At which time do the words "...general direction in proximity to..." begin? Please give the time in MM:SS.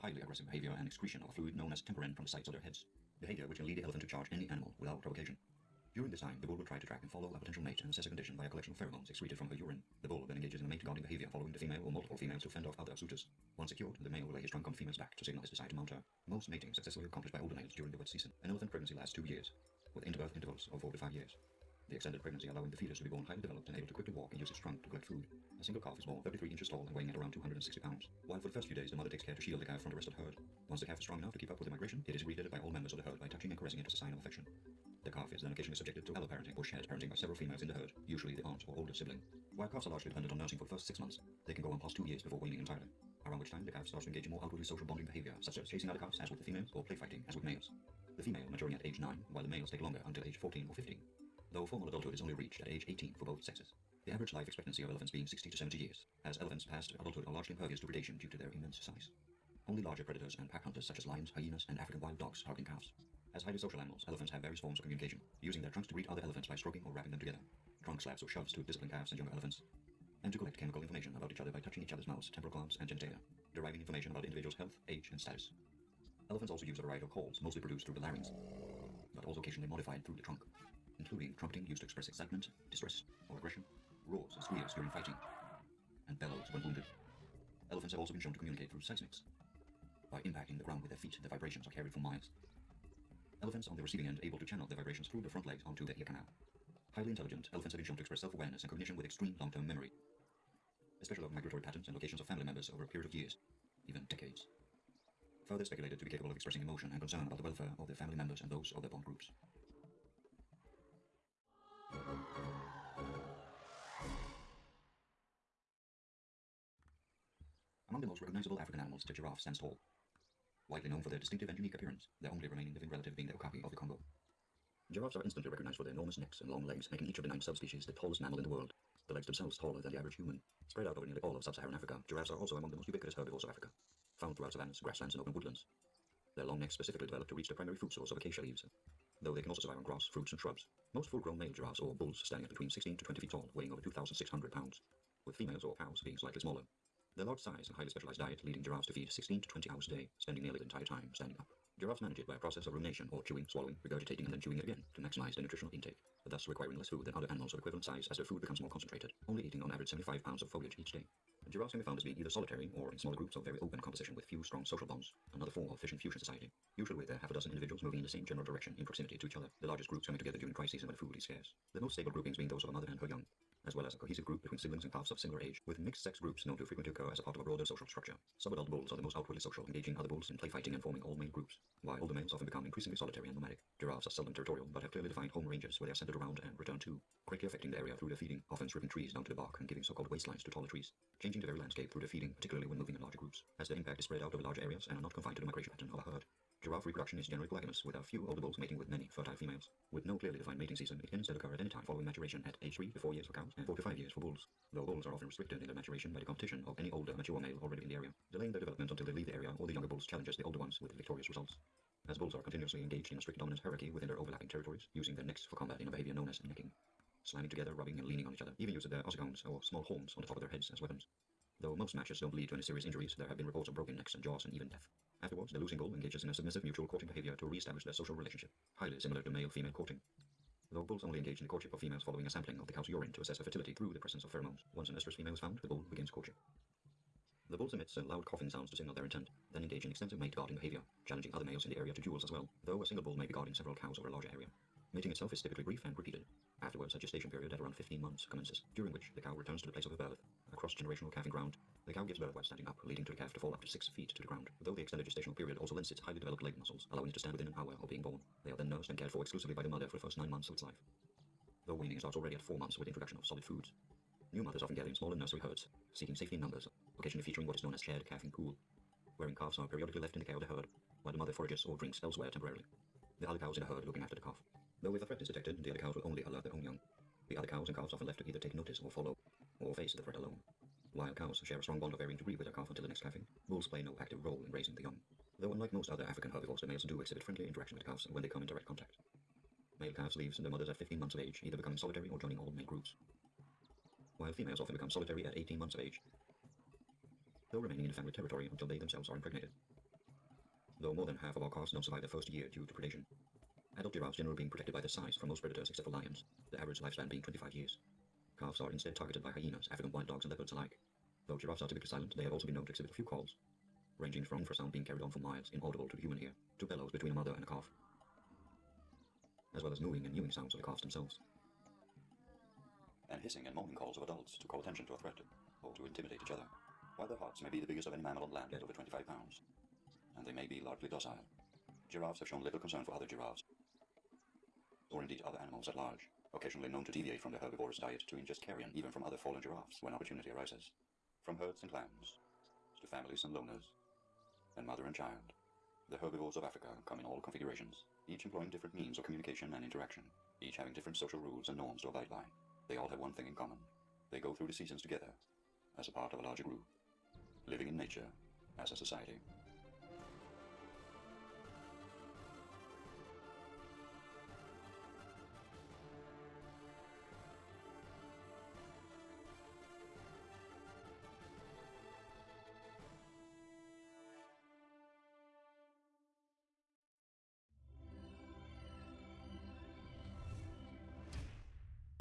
02:48.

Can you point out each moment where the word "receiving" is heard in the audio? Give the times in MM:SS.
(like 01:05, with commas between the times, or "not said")
01:33.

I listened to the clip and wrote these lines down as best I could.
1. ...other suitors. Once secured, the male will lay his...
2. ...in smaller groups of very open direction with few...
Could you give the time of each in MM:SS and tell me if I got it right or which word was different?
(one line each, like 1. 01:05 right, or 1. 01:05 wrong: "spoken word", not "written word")
1. 00:12 right
2. 02:42 wrong: "composition", not "direction".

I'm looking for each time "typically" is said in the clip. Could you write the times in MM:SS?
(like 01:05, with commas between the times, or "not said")
04:05, 05:11.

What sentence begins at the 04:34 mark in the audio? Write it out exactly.
Though if a threat is detected, the other cows will only alert their own young.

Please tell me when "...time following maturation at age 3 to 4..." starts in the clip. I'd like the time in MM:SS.
03:21.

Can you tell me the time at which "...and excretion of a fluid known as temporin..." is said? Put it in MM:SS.
00:00.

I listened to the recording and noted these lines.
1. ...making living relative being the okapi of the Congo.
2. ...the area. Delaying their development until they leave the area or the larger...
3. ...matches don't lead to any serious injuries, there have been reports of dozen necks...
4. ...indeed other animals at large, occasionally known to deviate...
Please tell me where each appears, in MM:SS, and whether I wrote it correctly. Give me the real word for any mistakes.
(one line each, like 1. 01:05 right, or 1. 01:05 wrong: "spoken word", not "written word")
1. 02:02 wrong: "remaining", not "making"
2. 03:27 wrong: "younger", not "larger"
3. 03:41 wrong: "broken", not "dozen"
4. 05:35 right.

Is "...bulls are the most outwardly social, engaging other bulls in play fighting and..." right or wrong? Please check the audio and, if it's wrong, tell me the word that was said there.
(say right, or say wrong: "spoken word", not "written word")
right.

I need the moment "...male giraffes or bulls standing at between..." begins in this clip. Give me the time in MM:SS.
02:21.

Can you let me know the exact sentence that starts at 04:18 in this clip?
They are then nursed and cared for exclusively by the mother for the first 9 months of its life.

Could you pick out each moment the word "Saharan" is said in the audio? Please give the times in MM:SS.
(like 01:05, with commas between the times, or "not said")
02:11.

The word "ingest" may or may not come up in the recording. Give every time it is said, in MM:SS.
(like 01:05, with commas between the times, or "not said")
05:38.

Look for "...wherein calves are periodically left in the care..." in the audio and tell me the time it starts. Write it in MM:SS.
04:29.